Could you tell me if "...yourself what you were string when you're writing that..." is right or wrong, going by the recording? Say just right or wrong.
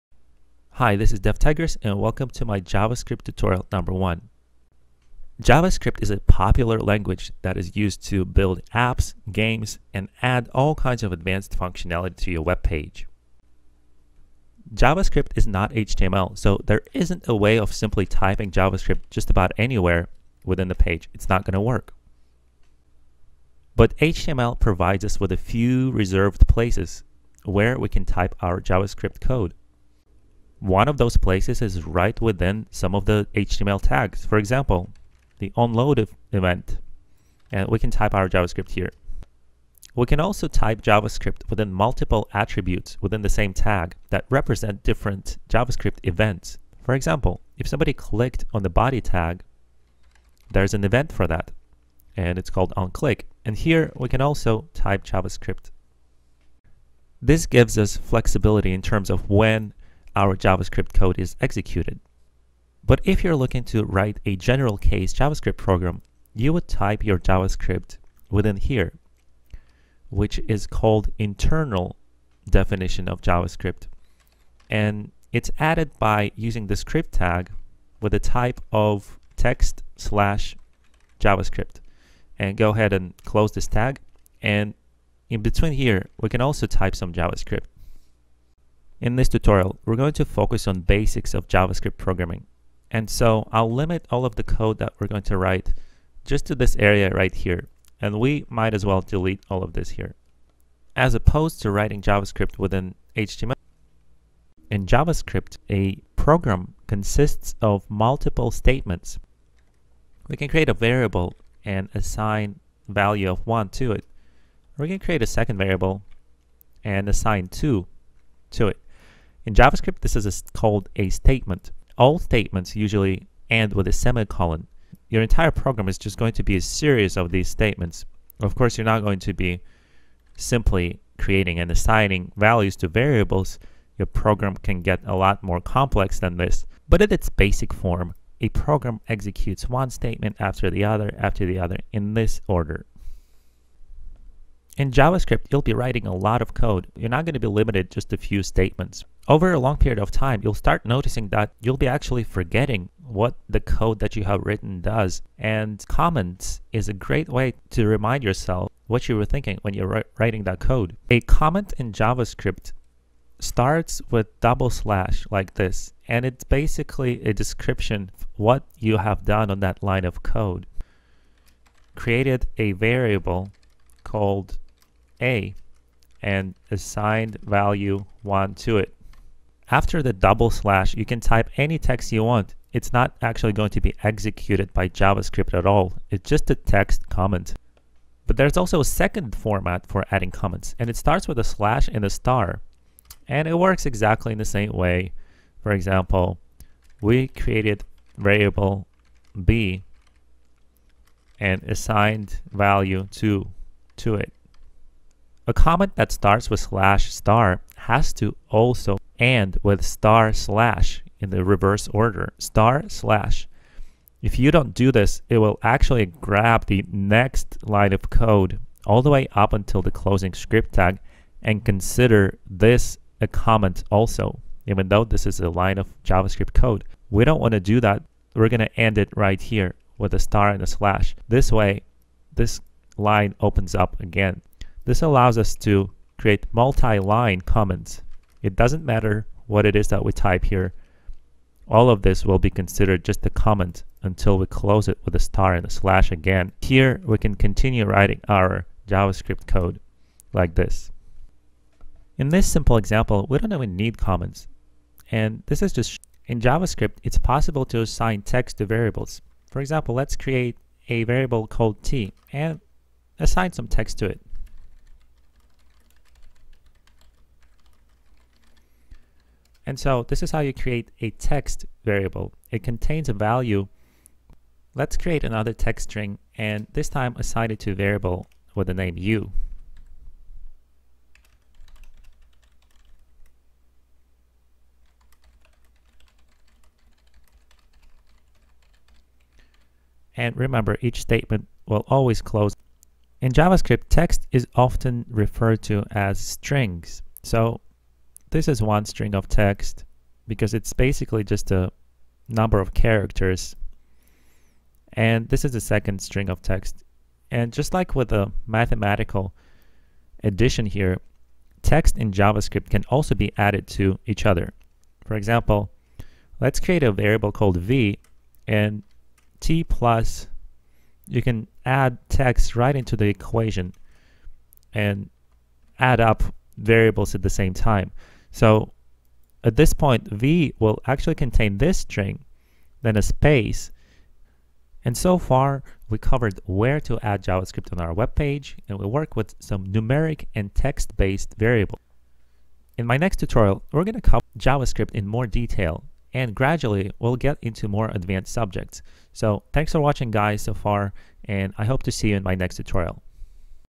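wrong.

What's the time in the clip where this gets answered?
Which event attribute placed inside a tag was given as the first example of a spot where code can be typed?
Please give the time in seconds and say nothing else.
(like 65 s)
35 s.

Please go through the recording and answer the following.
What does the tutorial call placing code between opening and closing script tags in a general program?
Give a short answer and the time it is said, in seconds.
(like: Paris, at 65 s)
internal definition, at 71 s.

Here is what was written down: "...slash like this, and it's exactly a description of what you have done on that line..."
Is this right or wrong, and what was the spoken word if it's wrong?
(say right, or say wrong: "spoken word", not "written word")
wrong: "basically", not "exactly".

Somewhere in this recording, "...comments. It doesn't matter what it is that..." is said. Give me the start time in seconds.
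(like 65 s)
237 s.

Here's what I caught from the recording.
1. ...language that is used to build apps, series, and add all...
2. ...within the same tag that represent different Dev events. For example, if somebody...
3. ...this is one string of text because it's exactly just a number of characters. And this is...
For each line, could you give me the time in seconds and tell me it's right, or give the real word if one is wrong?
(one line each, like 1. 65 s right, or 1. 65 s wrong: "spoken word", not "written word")
1. 6 s wrong: "games", not "series"
2. 43 s wrong: "JavaScript", not "Dev"
3. 298 s wrong: "basically", not "exactly".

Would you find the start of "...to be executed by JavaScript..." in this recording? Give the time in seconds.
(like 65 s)
183 s.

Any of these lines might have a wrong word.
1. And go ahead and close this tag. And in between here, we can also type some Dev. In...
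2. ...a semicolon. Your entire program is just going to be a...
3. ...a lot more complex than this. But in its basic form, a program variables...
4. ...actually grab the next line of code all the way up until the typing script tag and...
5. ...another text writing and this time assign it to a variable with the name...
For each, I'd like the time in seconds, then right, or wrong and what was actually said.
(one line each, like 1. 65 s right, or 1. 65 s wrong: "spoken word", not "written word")
1. 82 s wrong: "JavaScript", not "Dev"
2. 123 s right
3. 135 s wrong: "executes", not "variables"
4. 215 s wrong: "closing", not "typing"
5. 275 s wrong: "string", not "writing".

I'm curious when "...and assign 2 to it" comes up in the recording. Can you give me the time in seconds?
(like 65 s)
116 s.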